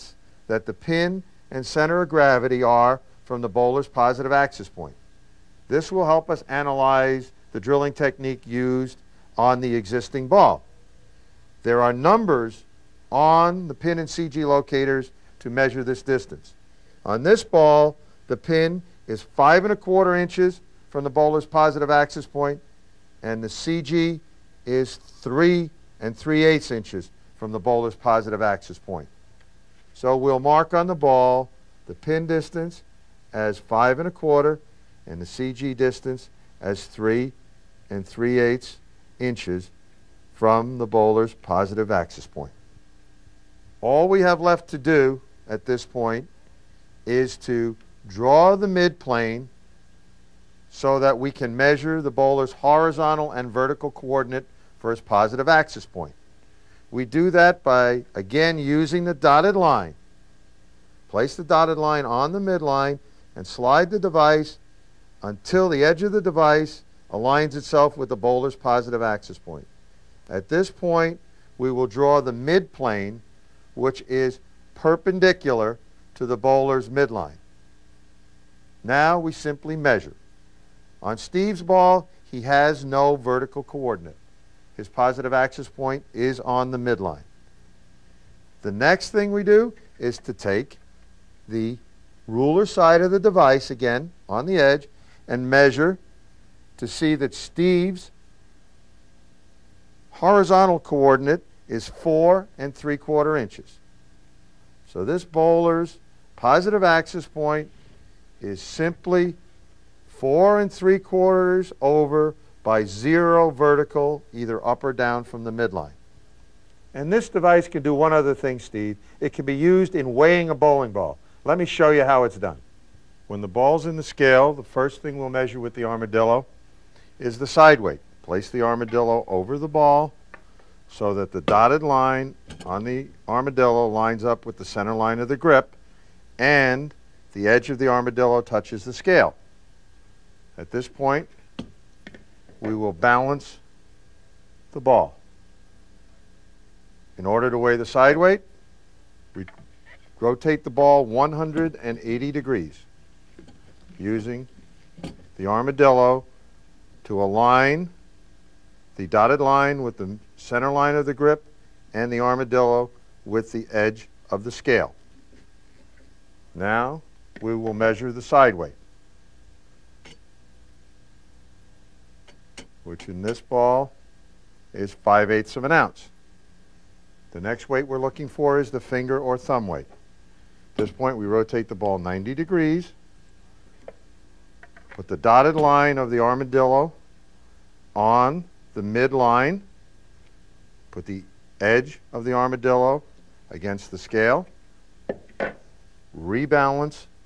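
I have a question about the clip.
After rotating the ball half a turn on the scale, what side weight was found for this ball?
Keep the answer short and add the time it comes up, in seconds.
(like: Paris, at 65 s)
5/8 ounce, at 174 s.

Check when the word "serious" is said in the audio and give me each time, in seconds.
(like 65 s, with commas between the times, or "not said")
not said.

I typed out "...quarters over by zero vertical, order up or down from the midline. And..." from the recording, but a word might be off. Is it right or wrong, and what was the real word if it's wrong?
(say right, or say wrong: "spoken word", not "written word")
wrong: "either", not "order".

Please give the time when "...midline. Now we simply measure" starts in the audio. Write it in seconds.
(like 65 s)
76 s.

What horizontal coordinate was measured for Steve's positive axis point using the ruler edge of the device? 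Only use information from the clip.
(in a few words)
4 3/4 inches.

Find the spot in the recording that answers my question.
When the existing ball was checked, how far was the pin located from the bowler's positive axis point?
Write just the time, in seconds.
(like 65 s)
19 s.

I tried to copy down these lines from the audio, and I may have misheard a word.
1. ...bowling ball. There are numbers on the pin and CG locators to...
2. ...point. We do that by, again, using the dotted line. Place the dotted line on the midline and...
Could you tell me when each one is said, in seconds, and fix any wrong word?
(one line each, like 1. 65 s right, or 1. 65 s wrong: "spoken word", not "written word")
1. 9 s wrong: "existing", not "bowling"
2. 55 s right.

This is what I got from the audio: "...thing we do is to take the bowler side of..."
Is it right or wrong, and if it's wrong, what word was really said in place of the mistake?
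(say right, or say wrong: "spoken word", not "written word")
wrong: "ruler", not "bowler".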